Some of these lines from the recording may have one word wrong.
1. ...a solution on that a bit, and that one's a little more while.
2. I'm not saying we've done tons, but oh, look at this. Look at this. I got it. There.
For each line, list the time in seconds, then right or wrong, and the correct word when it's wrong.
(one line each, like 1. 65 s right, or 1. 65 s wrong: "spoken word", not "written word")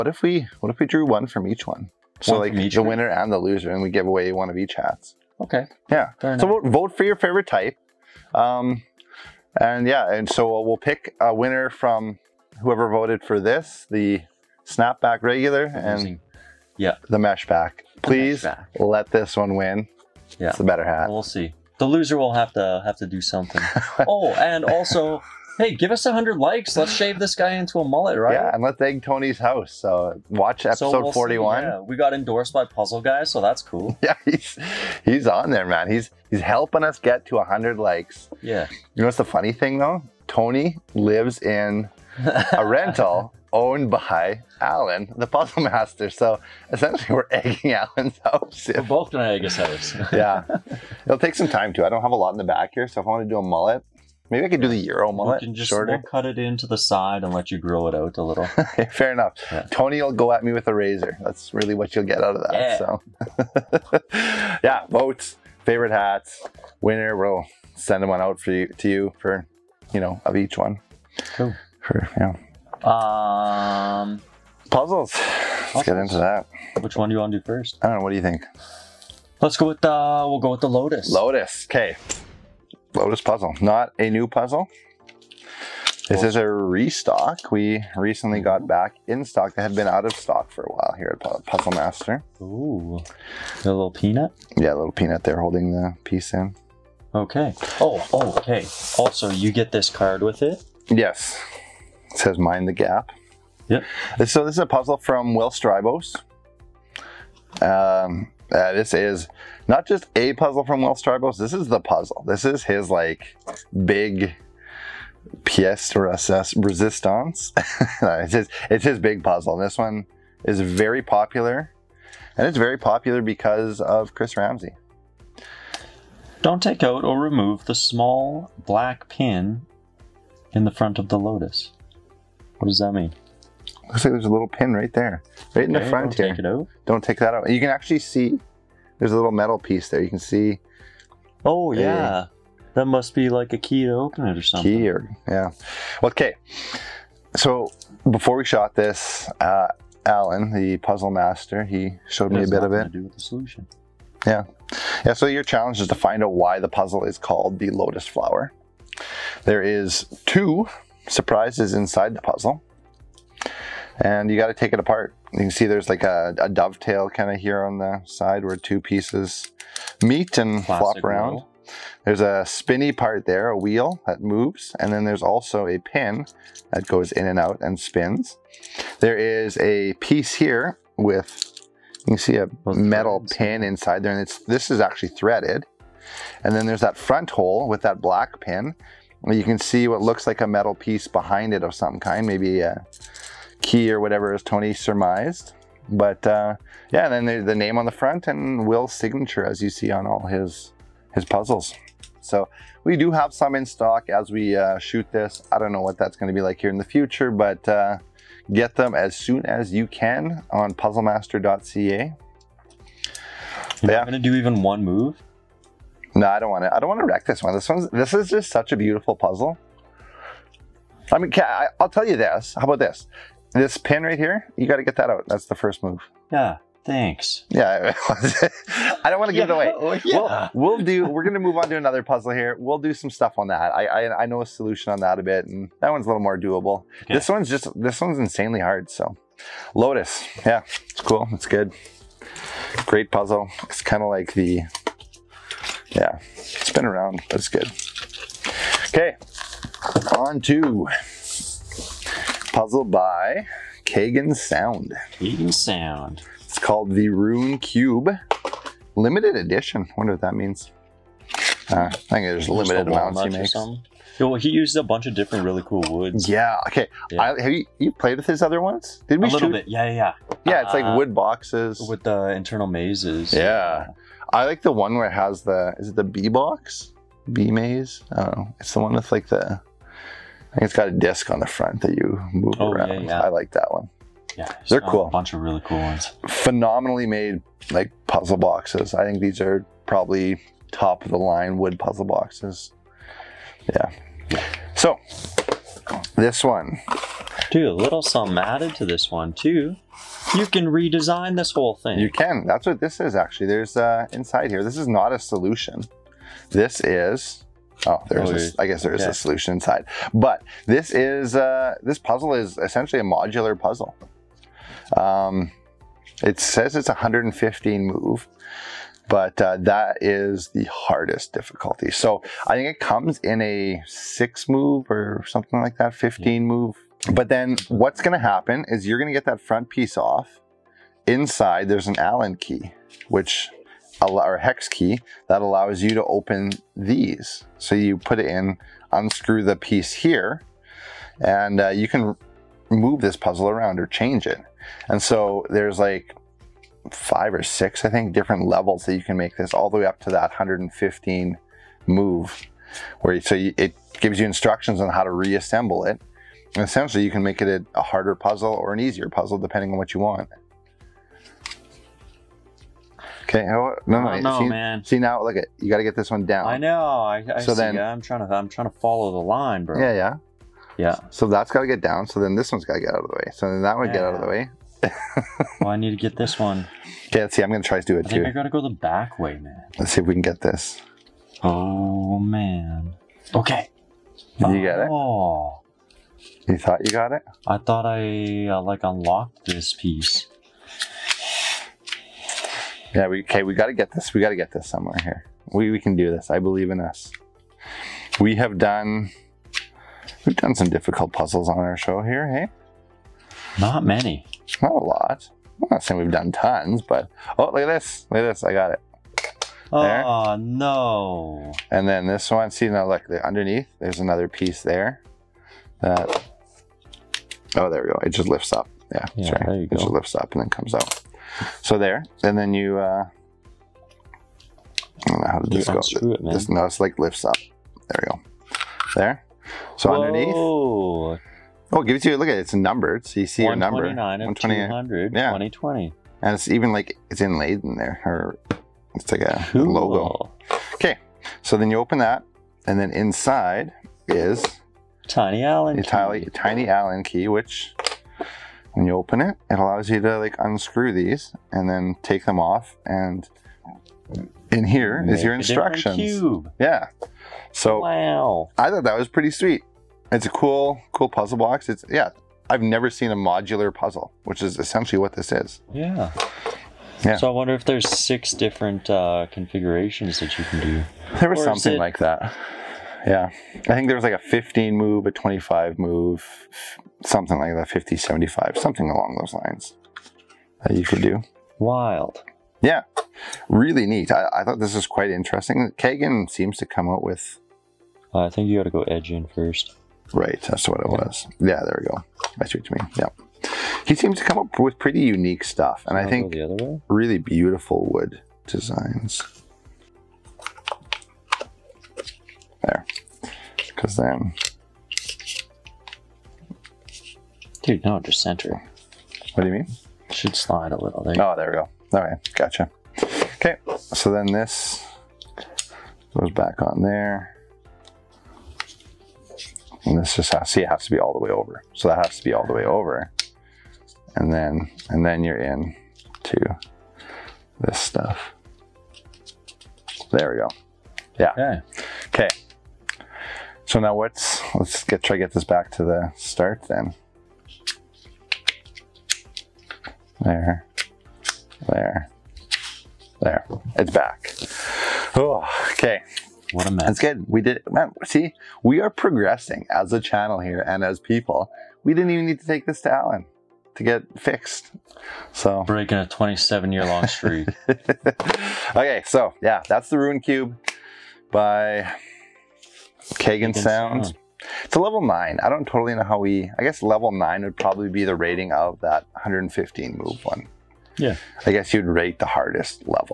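1. 234 s wrong: "doable", not "while"
2. 405 s right.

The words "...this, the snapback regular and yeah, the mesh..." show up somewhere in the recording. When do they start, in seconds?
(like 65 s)
13 s.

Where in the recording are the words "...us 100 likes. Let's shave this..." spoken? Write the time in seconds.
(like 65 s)
25 s.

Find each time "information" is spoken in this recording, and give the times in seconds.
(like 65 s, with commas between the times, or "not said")
not said.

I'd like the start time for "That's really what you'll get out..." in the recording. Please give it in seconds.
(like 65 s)
61 s.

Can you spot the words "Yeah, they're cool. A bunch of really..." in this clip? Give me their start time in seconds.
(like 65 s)
284 s.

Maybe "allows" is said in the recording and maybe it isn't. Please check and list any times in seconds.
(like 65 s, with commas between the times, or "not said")
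335 s, 449 s.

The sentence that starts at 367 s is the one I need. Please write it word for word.
I, I so then, I'm trying to.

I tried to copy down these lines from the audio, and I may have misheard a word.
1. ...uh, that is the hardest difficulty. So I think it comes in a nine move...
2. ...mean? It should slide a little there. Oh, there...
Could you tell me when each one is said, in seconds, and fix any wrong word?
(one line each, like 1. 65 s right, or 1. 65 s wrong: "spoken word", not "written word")
1. 319 s wrong: "six", not "nine"
2. 509 s right.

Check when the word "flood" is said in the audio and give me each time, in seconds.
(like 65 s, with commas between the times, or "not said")
not said.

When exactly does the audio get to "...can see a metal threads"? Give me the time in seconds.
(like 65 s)
182 s.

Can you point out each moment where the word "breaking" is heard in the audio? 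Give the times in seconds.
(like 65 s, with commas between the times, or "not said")
555 s.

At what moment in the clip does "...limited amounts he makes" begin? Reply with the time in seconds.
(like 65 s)
262 s.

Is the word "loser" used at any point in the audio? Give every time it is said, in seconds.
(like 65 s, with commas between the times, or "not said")
3 s, 21 s.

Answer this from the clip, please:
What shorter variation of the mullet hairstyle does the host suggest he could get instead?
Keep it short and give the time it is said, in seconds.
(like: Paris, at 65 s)
Euro mullet, at 54 s.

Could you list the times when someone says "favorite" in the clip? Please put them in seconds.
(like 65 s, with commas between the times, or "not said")
7 s, 65 s.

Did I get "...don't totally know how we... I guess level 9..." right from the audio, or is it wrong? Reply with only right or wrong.
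right.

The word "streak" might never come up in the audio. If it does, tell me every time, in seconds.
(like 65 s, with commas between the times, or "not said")
557 s.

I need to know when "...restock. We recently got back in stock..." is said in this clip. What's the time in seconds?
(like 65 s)
86 s.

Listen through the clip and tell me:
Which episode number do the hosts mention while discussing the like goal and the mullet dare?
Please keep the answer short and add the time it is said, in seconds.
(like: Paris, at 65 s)
41, at 31 s.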